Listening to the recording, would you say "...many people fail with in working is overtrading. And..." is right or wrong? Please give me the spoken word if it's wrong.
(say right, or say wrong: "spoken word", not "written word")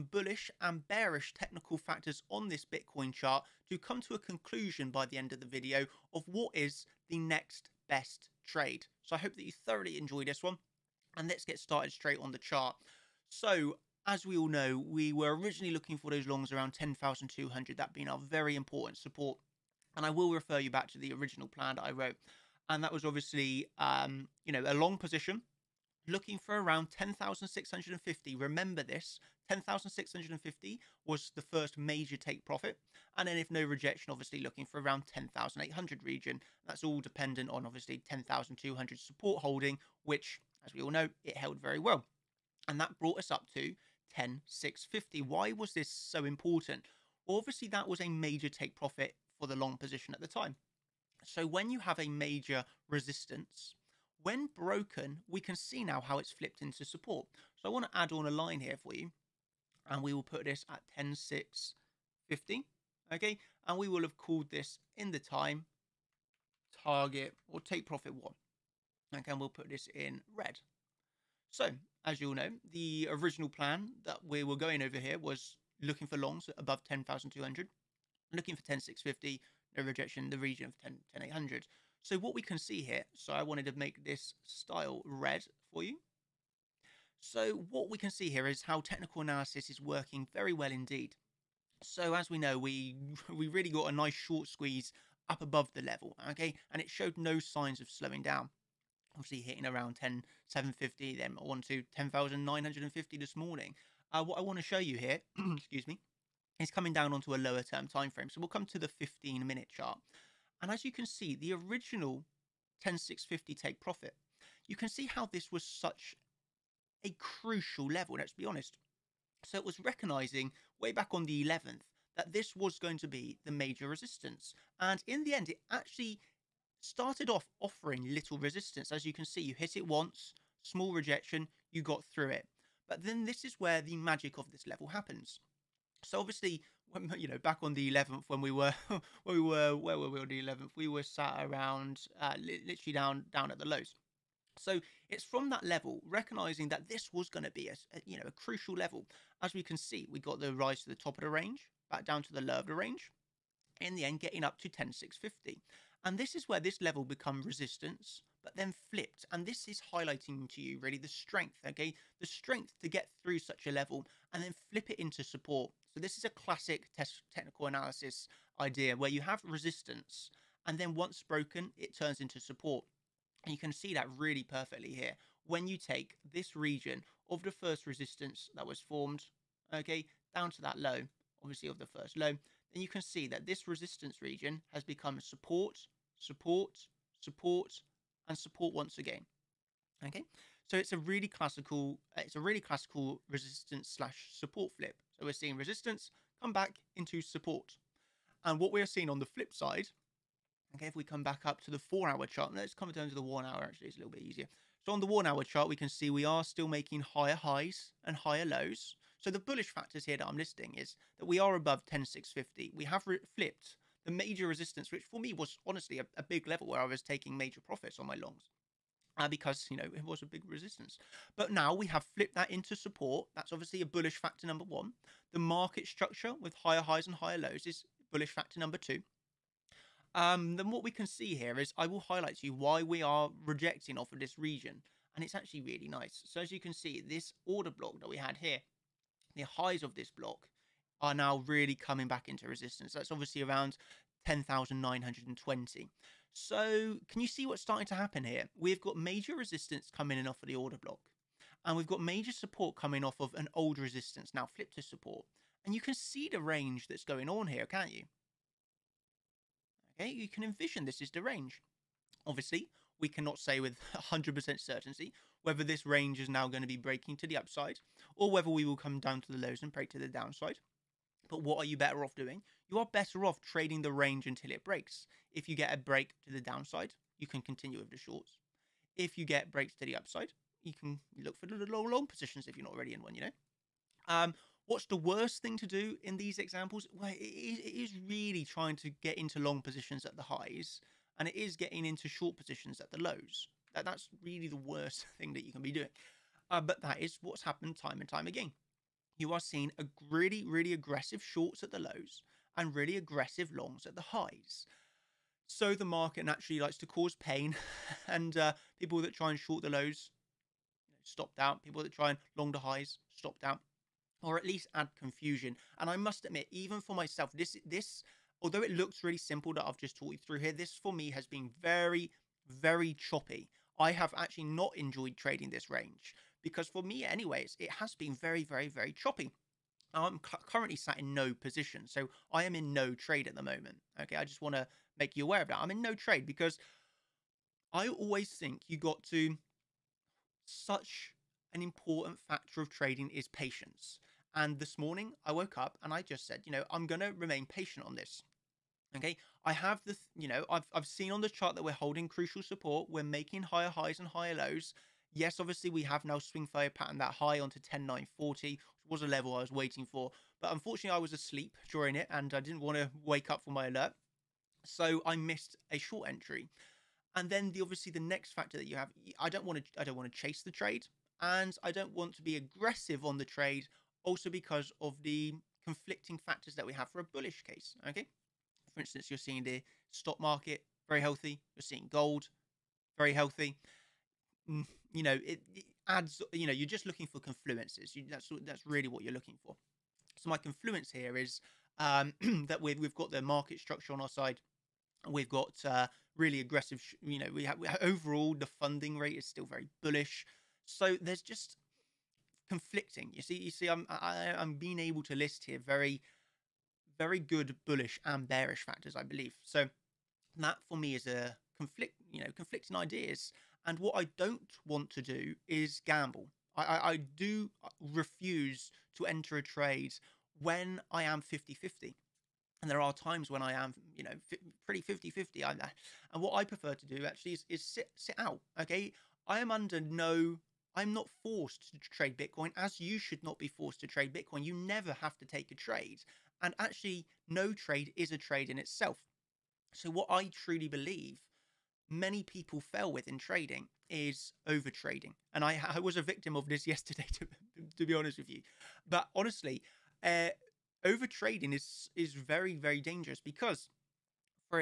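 wrong: "trading", not "working".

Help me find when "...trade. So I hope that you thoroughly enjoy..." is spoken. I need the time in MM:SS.
00:08.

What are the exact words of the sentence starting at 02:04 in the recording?
And in the end, it actually started off offering little resistance.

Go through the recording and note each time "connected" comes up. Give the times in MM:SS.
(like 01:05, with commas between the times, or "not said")
not said.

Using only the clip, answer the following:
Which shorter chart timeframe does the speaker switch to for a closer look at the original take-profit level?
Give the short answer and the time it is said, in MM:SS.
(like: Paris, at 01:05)
15 minute, at 01:48.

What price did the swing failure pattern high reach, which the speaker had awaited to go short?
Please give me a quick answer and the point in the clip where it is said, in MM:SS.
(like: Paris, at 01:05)
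10940, at 05:57.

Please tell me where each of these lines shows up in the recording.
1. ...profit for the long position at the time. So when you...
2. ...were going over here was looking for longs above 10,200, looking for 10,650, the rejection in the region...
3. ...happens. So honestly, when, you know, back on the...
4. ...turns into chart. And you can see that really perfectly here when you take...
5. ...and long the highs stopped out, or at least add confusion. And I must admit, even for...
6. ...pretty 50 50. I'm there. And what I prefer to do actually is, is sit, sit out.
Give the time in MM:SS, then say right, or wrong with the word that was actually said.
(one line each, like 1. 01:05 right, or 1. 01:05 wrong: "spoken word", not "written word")
1. 00:48 right
2. 01:14 right
3. 02:14 wrong: "obviously", not "honestly"
4. 02:51 wrong: "support", not "chart"
5. 05:12 right
6. 07:04 right.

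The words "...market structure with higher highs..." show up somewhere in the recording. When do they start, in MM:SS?
03:45.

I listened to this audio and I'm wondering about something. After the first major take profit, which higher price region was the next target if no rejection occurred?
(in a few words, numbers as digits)
10,800.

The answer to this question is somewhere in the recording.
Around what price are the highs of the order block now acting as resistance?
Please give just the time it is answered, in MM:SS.
04:04.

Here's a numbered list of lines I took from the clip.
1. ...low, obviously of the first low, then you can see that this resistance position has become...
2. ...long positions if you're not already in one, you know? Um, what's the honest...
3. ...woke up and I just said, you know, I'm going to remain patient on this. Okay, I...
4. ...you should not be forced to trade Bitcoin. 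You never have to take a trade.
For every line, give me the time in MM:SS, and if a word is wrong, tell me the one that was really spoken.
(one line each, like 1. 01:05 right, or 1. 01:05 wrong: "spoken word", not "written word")
1. 03:00 wrong: "region", not "position"
2. 04:41 wrong: "worst", not "honest"
3. 05:45 right
4. 07:12 right.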